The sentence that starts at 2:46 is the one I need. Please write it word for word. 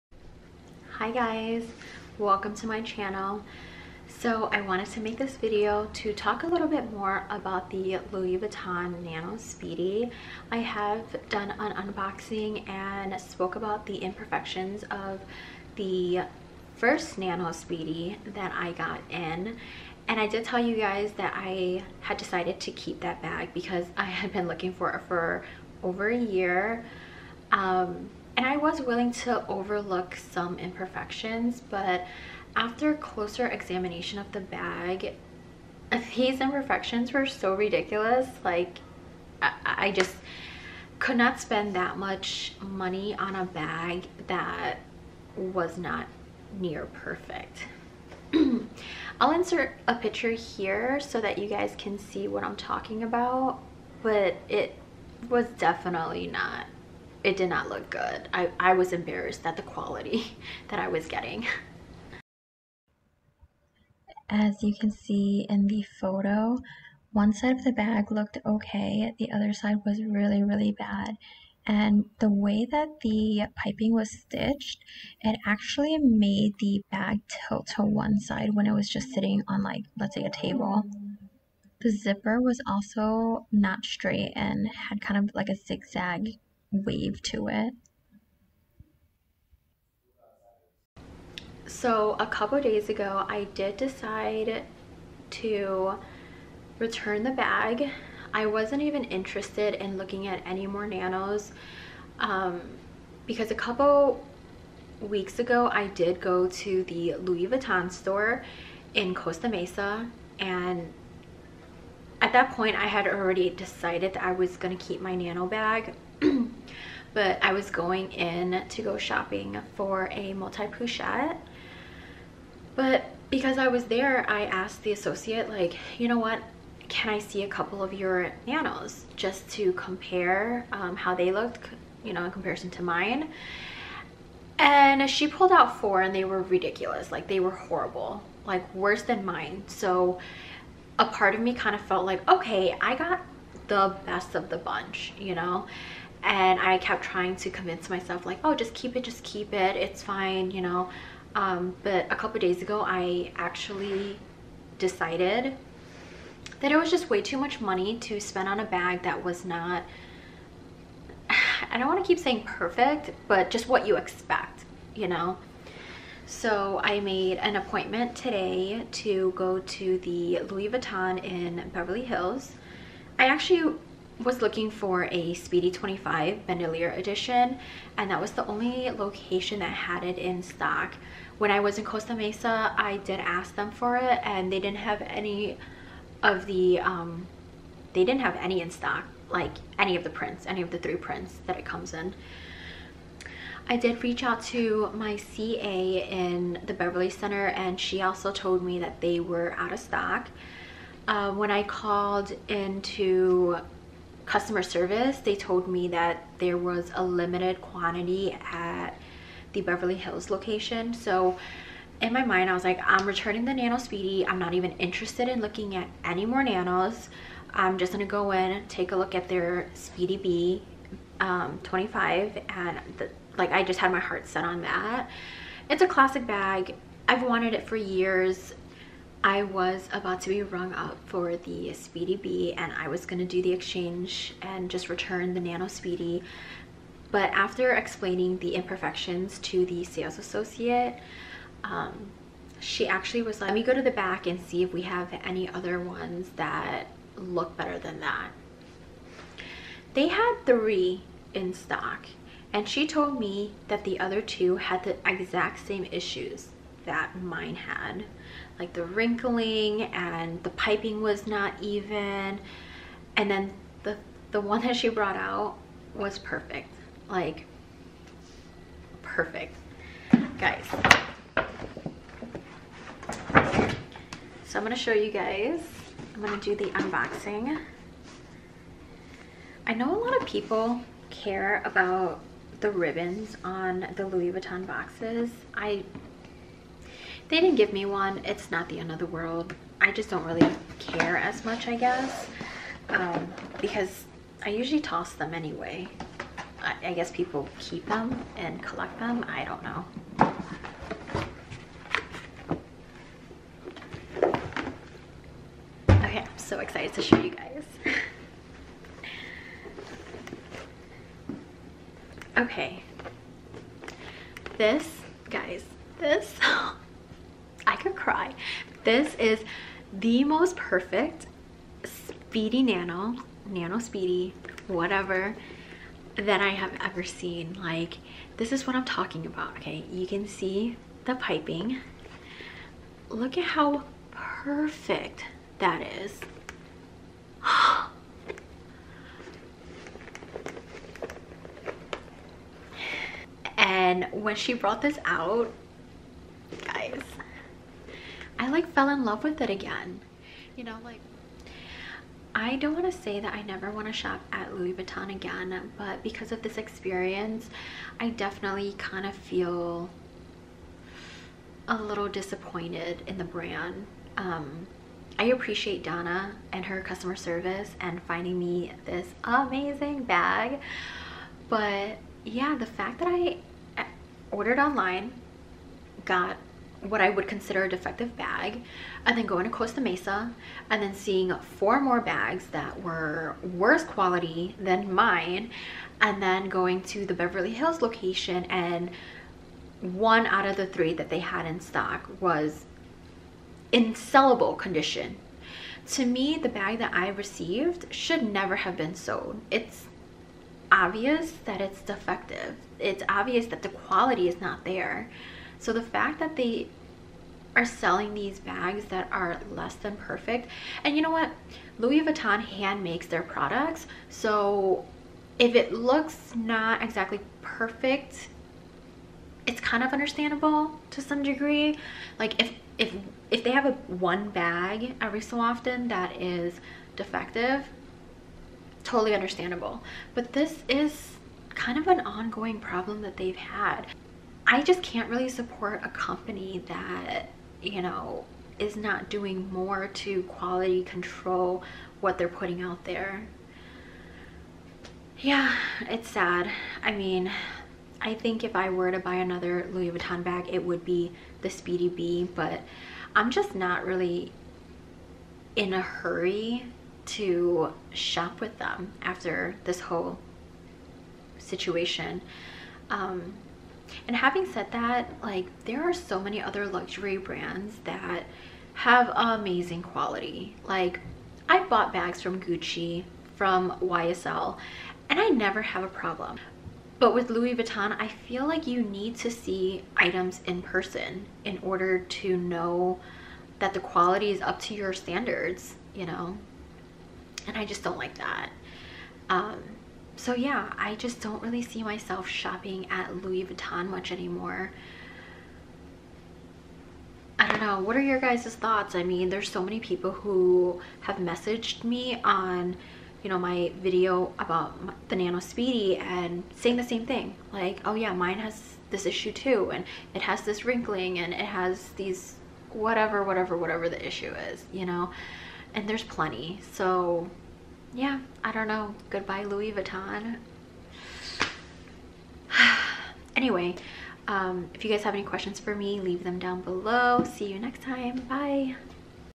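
So I made an appointment today to go to the Louis Vuitton in Beverly Hills.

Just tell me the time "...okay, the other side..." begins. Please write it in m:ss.
1:08.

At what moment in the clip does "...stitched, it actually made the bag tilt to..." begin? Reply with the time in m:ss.
1:14.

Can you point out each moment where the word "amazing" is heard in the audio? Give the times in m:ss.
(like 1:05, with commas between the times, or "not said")
6:09, 7:49.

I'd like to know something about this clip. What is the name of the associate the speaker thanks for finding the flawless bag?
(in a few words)
Donna.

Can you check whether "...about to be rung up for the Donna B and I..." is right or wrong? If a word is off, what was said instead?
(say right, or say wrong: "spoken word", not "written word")
wrong: "Speedy", not "Donna".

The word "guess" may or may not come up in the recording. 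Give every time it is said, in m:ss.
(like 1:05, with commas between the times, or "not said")
4:51, 4:56.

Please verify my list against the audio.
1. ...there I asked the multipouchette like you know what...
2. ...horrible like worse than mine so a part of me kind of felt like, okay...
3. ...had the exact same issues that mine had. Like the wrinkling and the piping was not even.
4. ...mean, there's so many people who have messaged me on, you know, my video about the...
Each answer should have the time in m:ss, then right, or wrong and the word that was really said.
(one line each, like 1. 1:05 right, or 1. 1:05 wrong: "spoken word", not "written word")
1. 2:03 wrong: "associate", not "multipouchette"
2. 2:17 right
3. 4:14 right
4. 8:19 right.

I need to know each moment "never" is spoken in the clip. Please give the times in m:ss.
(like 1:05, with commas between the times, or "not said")
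5:53, 6:38, 7:55.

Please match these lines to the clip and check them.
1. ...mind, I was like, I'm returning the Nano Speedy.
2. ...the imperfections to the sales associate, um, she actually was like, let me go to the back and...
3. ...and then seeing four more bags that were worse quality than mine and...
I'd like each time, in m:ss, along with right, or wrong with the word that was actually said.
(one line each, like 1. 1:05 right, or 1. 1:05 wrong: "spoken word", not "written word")
1. 3:32 right
2. 3:58 right
3. 6:20 right.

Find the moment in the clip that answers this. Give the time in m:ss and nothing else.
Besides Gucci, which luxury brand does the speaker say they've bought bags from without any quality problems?
7:53.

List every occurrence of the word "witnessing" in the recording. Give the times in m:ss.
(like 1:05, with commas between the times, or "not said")
not said.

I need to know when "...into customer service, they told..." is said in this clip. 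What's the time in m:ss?
3:22.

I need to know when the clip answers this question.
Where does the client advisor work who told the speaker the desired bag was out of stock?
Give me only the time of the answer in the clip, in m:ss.
3:16.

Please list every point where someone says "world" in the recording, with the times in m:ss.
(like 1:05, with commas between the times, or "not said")
4:49.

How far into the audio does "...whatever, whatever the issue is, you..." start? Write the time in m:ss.
8:33.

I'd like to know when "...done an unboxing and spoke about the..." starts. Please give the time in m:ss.
0:11.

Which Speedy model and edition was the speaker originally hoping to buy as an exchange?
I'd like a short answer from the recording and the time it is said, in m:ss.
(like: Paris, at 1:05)
Speedy 25 Bandolier, at 2:55.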